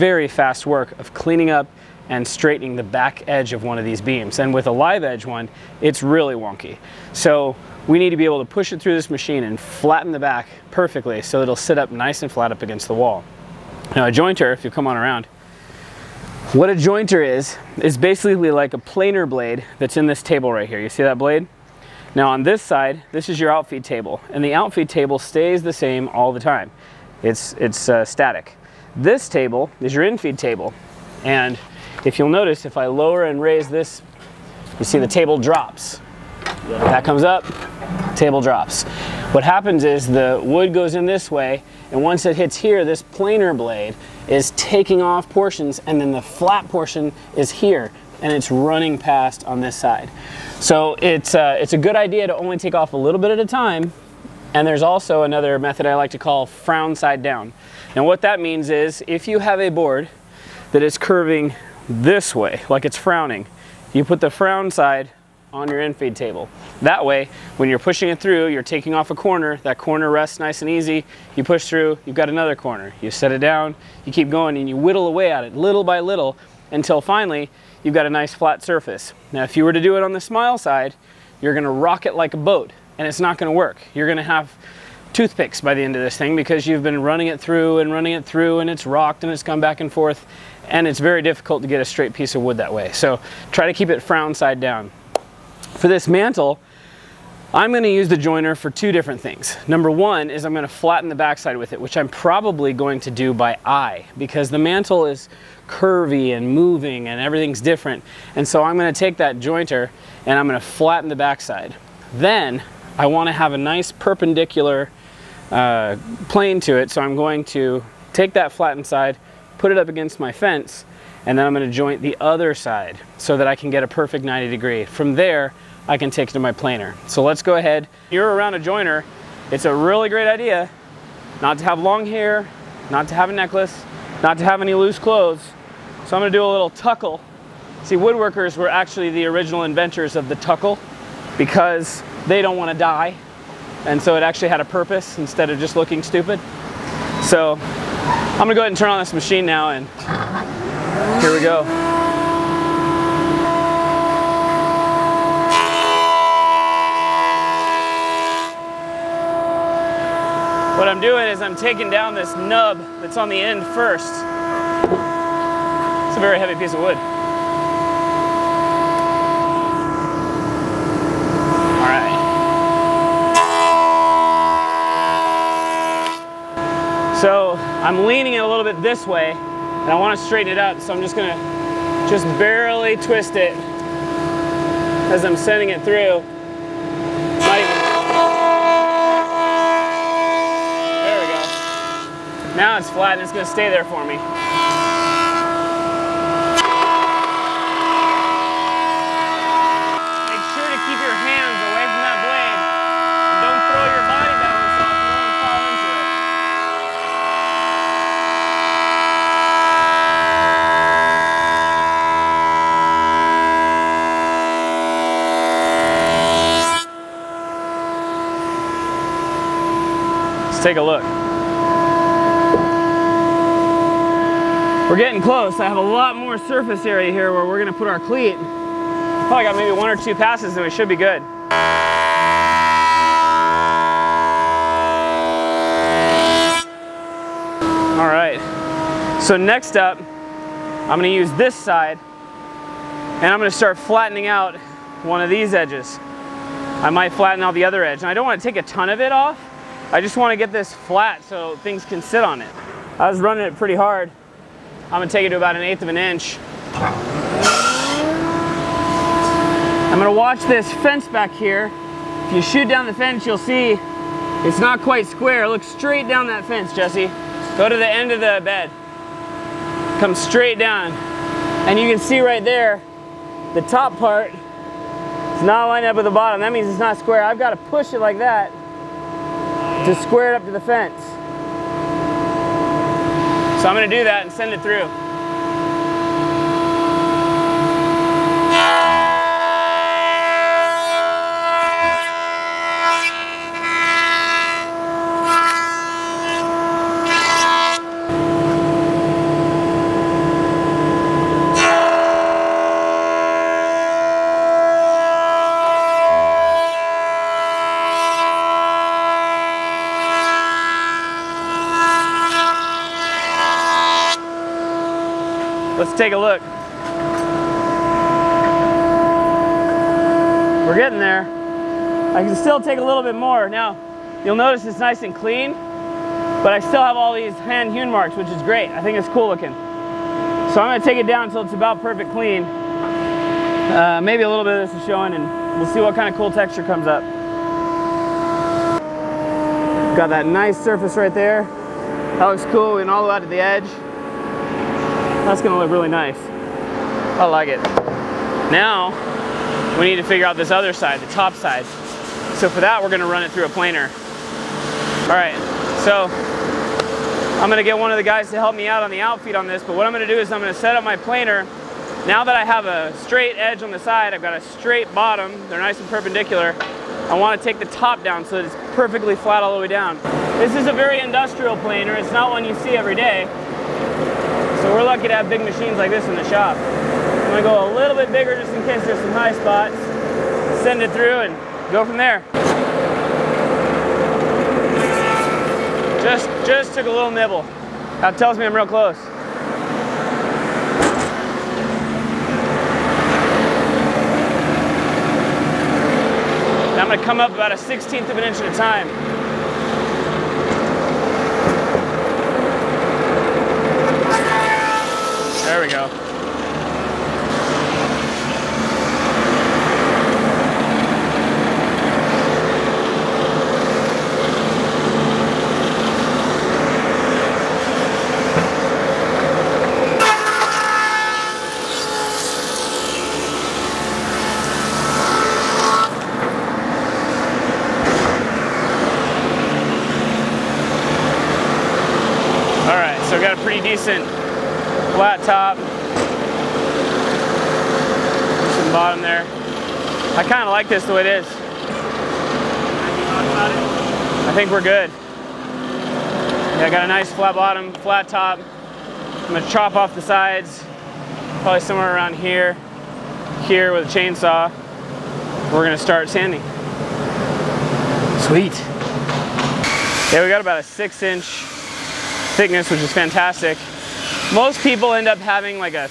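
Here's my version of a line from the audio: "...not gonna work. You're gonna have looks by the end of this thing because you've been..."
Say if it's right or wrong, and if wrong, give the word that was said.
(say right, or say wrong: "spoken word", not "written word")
wrong: "toothpicks", not "looks".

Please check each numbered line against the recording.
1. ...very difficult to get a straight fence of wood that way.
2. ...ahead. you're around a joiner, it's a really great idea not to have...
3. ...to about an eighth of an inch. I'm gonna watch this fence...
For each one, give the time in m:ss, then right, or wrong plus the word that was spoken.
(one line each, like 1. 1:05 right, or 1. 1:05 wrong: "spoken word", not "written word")
1. 1:31 wrong: "piece", not "fence"
2. 2:07 right
3. 4:15 right.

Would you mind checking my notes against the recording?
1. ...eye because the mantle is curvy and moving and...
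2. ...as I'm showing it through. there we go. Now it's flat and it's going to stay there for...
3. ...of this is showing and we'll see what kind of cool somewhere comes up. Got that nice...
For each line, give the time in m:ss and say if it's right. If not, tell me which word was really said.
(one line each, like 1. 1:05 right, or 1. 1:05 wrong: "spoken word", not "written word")
1. 1:43 right
2. 3:05 wrong: "sending", not "showing"
3. 5:34 wrong: "texture", not "somewhere".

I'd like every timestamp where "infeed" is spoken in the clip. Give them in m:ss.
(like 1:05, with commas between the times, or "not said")
0:30, 1:05.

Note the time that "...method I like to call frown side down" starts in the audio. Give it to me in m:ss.
0:55.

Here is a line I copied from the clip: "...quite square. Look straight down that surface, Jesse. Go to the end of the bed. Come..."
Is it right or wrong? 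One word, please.
wrong.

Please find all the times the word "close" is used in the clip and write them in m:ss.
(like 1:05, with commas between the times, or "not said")
3:45, 6:28.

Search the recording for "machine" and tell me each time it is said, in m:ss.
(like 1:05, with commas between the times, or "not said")
0:09, 2:29, 6:15.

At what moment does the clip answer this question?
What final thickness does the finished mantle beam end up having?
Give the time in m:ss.
7:40.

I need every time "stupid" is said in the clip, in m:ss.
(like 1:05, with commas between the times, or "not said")
2:26.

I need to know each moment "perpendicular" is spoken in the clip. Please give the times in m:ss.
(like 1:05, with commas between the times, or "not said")
1:53, 6:05.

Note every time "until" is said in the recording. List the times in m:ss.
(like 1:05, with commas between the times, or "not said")
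1:16, 5:31.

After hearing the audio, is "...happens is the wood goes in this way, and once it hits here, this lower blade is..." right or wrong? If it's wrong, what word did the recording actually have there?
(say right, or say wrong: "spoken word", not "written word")
wrong: "planer", not "lower".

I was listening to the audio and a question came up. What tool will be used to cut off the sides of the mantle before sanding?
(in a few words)
chainsaw.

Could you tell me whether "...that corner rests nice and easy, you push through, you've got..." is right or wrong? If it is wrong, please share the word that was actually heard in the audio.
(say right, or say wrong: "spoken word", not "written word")
right.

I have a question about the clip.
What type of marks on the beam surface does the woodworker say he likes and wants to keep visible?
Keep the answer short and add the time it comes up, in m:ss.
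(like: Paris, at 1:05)
hand hewn marks, at 5:27.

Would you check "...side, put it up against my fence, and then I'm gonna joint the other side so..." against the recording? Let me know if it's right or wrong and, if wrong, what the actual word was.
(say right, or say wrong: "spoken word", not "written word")
right.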